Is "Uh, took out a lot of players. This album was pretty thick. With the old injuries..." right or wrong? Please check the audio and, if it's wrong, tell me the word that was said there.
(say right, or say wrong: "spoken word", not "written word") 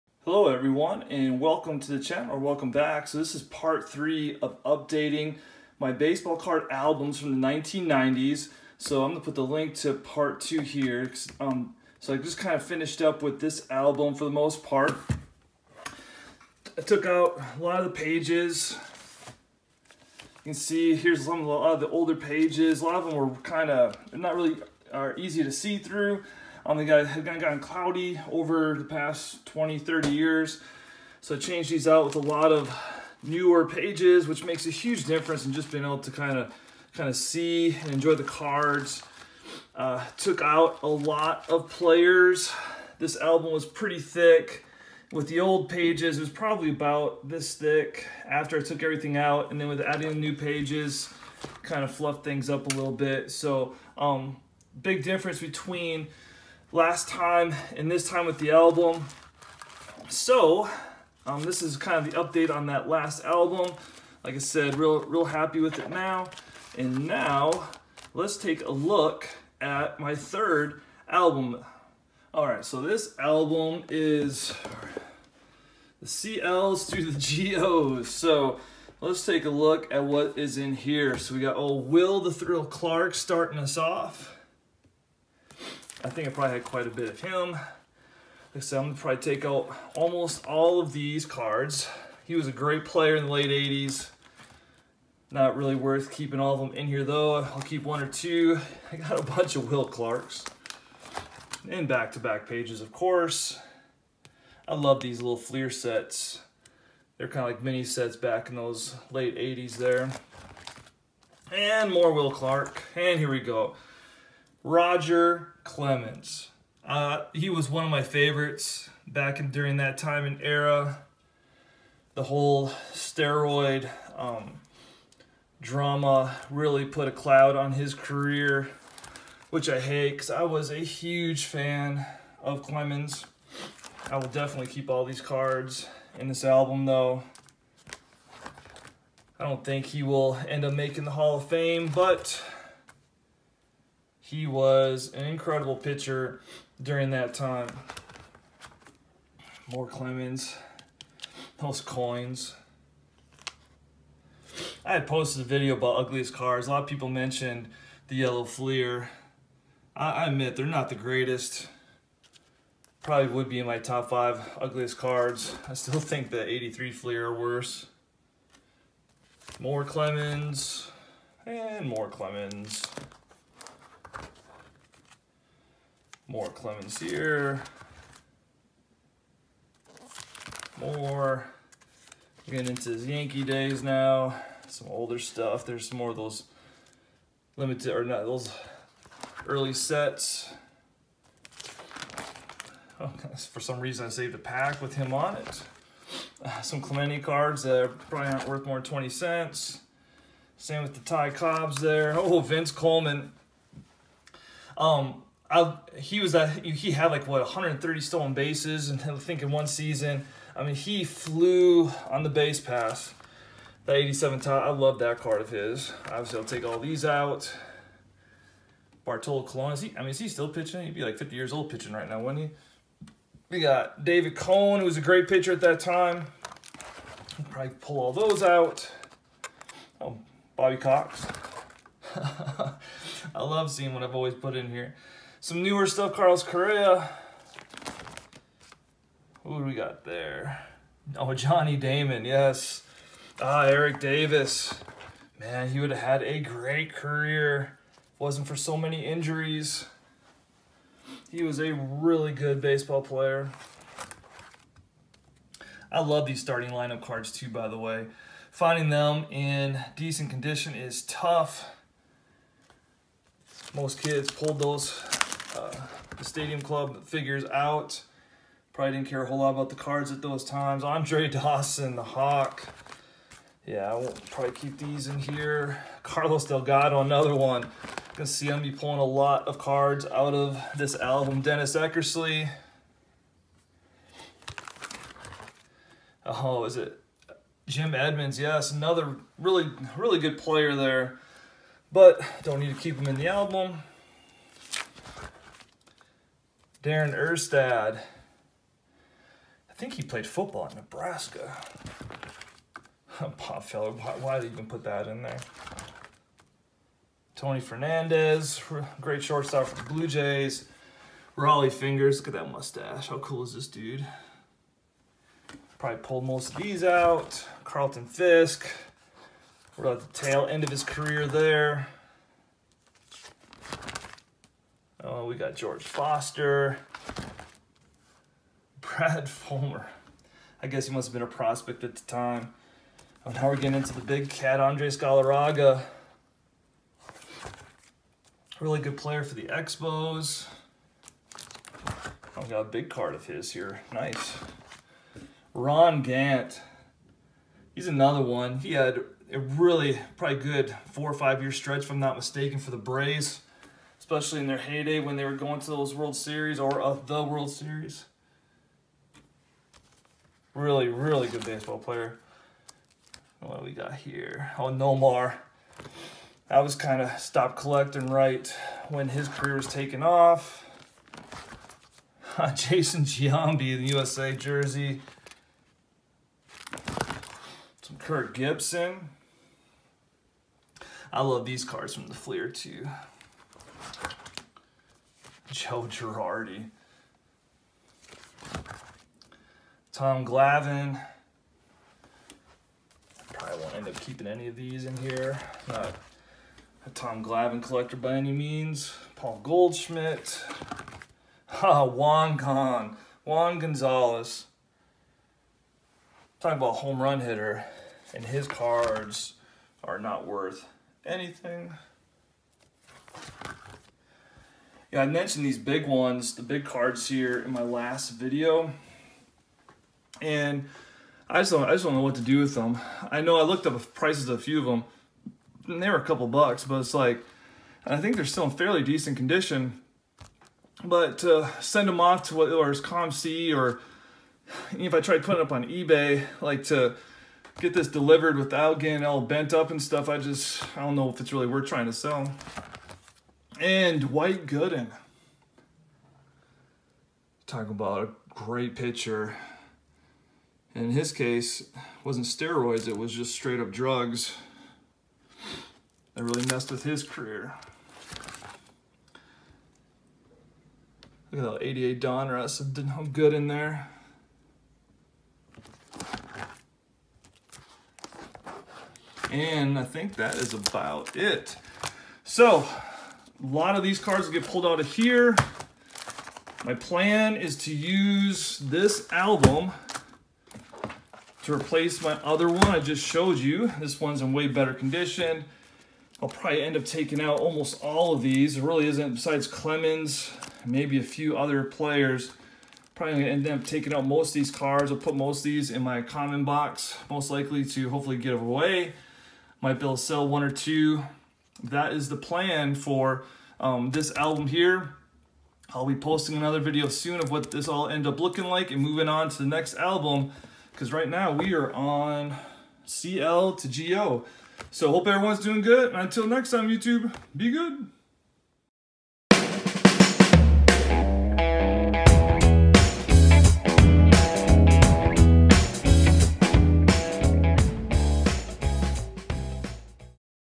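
wrong: "pages", not "injuries".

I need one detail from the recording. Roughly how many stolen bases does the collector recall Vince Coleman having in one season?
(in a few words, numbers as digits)
130.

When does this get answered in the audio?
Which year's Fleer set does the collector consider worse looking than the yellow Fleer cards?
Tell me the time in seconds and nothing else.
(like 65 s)
166 s.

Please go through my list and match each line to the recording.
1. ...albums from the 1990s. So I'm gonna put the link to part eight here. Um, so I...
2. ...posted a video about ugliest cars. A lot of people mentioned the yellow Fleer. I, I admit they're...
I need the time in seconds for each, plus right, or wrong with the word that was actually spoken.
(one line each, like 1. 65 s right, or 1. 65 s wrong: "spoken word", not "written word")
1. 6 s wrong: "two", not "eight"
2. 155 s right.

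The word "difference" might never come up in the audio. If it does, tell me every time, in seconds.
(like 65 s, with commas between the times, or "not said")
35 s, 55 s.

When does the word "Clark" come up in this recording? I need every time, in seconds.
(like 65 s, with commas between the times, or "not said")
82 s, 99 s, 112 s.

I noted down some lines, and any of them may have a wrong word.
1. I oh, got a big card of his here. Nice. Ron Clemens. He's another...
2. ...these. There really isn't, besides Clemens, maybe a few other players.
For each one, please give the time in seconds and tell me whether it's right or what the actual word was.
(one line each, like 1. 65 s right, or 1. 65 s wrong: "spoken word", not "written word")
1. 341 s wrong: "Gant", not "Clemens"
2. 488 s right.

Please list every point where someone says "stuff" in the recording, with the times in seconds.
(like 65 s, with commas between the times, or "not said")
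185 s, 235 s, 439 s.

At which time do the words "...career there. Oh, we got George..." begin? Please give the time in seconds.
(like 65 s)
320 s.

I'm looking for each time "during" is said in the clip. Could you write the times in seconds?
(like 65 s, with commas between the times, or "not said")
119 s, 146 s.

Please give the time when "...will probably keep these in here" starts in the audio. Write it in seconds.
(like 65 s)
273 s.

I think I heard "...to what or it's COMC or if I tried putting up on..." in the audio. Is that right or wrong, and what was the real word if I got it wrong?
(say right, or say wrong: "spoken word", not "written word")
right.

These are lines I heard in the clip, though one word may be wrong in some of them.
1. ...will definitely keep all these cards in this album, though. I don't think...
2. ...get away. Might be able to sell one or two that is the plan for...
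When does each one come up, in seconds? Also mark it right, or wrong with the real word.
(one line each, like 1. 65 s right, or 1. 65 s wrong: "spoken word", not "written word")
1. 134 s right
2. 498 s right.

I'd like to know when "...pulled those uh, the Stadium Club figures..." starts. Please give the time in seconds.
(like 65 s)
264 s.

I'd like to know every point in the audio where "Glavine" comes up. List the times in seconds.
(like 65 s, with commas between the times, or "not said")
390 s, 397 s.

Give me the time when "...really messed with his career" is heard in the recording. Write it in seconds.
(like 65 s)
456 s.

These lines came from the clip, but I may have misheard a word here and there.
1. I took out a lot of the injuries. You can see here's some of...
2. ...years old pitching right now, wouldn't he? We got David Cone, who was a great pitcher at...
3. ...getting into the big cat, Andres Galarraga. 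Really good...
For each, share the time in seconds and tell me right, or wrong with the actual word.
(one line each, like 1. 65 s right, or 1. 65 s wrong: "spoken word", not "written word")
1. 16 s wrong: "pages", not "injuries"
2. 221 s right
3. 333 s right.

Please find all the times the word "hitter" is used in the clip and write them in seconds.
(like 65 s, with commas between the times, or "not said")
407 s.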